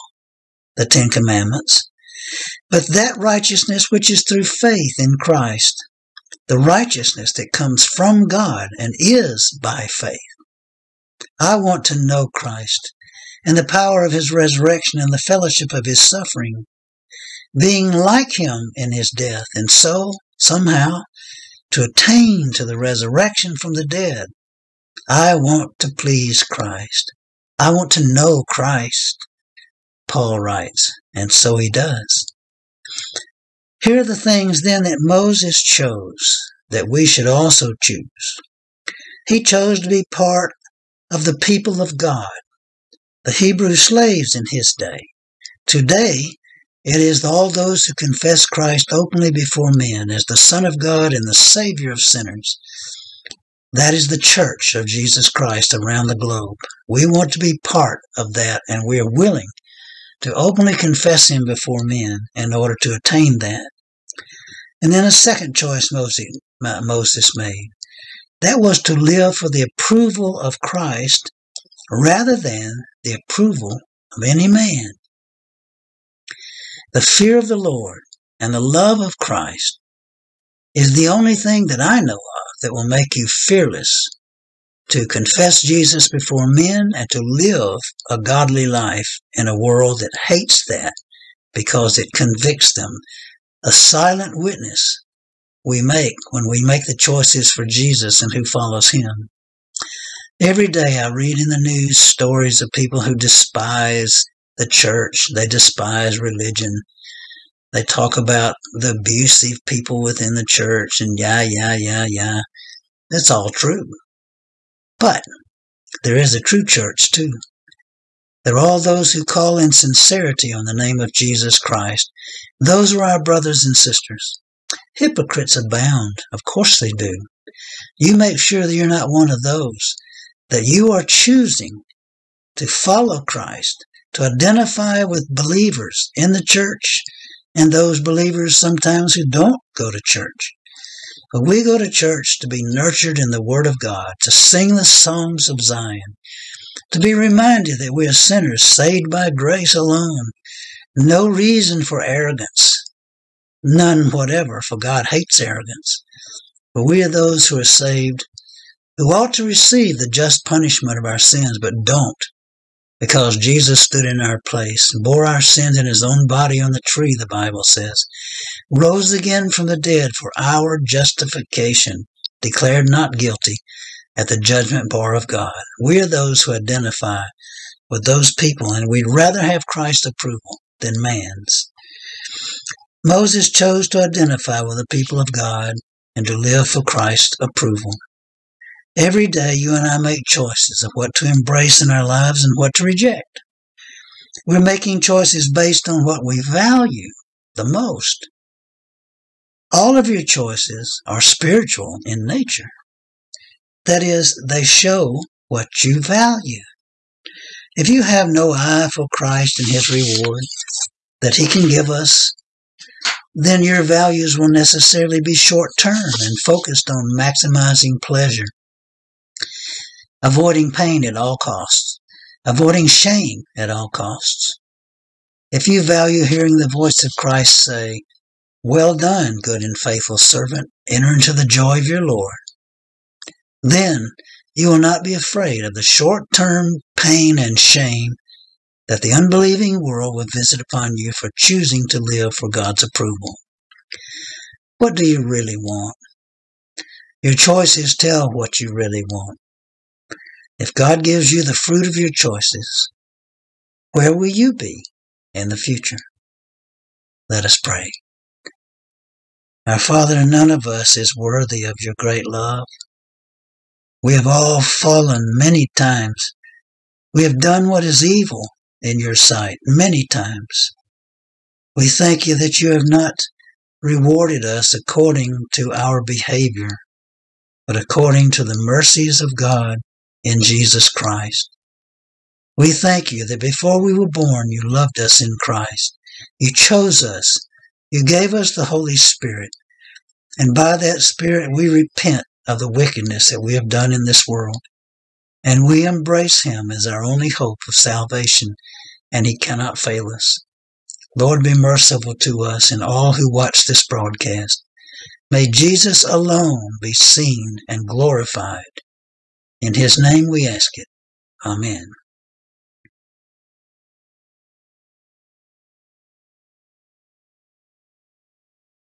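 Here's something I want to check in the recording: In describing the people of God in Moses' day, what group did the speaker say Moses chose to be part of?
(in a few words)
the Hebrew slaves.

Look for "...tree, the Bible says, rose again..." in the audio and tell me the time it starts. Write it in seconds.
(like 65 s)
166 s.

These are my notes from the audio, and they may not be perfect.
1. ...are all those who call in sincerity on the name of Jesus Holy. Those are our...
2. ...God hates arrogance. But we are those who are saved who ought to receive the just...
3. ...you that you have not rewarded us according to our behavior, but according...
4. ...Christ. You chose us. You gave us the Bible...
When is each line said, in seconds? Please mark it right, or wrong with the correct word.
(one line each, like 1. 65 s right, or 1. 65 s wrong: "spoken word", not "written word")
1. 118 s wrong: "Christ", not "Holy"
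2. 154 s right
3. 272 s right
4. 285 s wrong: "Holy", not "Bible".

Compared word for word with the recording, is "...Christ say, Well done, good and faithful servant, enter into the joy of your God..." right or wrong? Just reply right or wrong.
wrong.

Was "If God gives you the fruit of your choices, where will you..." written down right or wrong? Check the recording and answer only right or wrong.
right.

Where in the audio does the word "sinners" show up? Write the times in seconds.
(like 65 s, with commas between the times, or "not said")
51 s, 148 s.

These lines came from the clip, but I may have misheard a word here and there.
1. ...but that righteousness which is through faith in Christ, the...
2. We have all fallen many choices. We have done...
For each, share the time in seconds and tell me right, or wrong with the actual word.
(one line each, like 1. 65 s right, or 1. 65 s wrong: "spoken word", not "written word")
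1. 2 s right
2. 264 s wrong: "times", not "choices".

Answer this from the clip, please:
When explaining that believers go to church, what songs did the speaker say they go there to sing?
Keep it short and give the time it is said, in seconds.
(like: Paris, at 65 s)
the songs of Zion, at 144 s.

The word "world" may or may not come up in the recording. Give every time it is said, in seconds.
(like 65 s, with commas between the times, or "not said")
89 s, 239 s, 294 s.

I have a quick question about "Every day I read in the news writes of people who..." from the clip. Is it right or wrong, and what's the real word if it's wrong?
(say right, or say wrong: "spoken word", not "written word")
wrong: "stories", not "writes".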